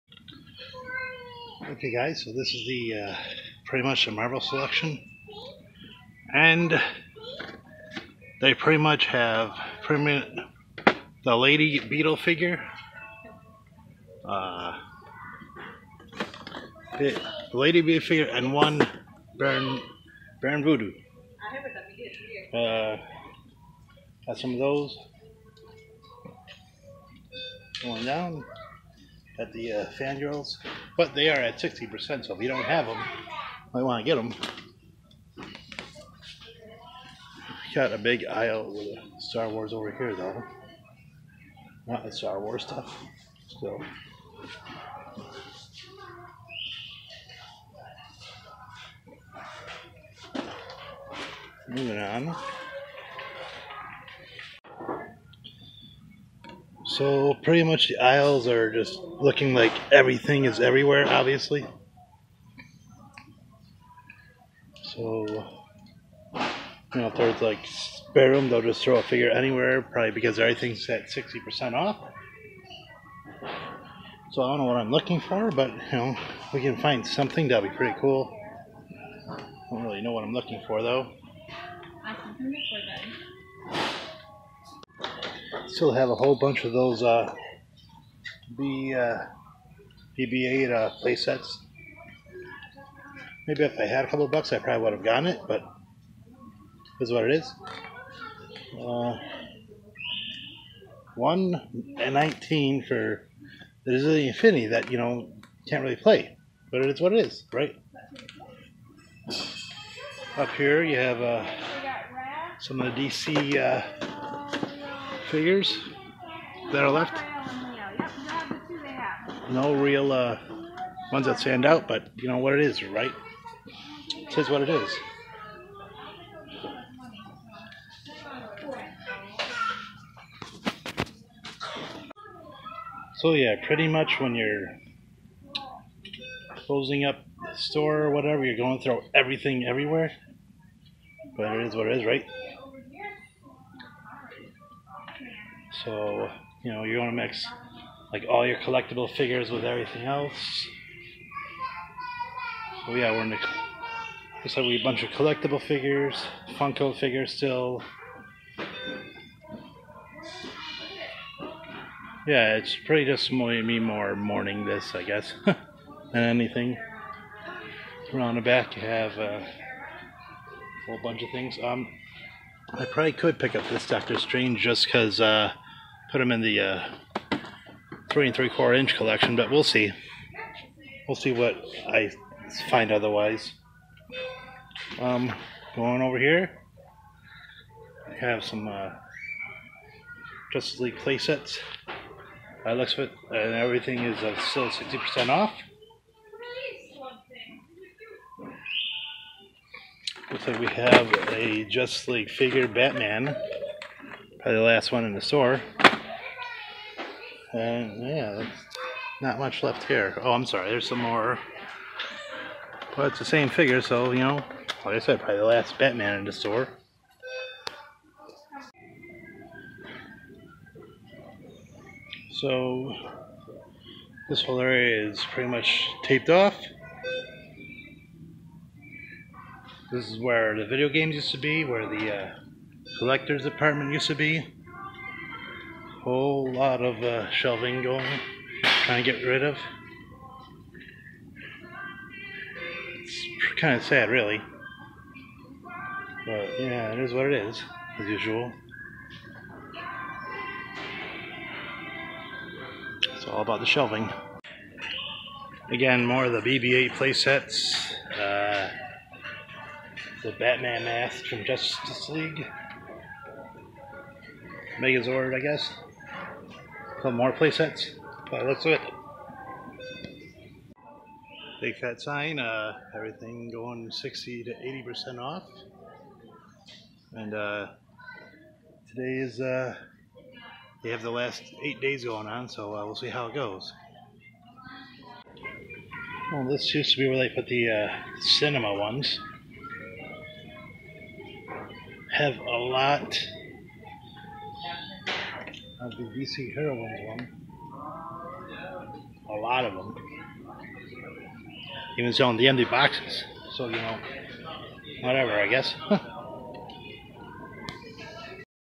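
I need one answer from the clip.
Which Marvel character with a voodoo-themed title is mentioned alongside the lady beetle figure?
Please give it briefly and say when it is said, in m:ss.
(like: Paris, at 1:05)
Baron Voodoo, at 0:20.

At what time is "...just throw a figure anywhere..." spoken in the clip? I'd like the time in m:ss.
1:08.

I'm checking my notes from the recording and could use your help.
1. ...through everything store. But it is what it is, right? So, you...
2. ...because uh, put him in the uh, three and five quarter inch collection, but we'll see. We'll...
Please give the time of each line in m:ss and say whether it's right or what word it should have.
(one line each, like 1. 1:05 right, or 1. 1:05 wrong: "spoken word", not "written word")
1. 2:18 wrong: "everywhere", not "store"
2. 2:54 wrong: "three", not "five".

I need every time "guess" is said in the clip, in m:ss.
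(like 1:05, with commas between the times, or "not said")
2:45, 4:25, 5:05.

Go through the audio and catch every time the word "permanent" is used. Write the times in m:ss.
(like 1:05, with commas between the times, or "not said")
0:09.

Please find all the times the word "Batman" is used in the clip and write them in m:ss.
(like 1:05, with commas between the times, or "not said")
3:22, 3:35, 4:20.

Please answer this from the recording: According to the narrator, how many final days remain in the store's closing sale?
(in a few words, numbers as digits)
8.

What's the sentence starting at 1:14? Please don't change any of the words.
So I don't know what I'm looking for, but, you know, we can find something, that'll be pretty cool.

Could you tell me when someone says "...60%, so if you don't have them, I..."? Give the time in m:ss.
0:31.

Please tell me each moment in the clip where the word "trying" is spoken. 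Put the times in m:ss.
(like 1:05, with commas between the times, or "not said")
3:58.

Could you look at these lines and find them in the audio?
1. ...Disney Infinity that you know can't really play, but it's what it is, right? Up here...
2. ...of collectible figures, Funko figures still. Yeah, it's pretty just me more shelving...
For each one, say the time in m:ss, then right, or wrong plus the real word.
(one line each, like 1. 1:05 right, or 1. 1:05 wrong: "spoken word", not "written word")
1. 1:43 right
2. 2:35 wrong: "mourning", not "shelving".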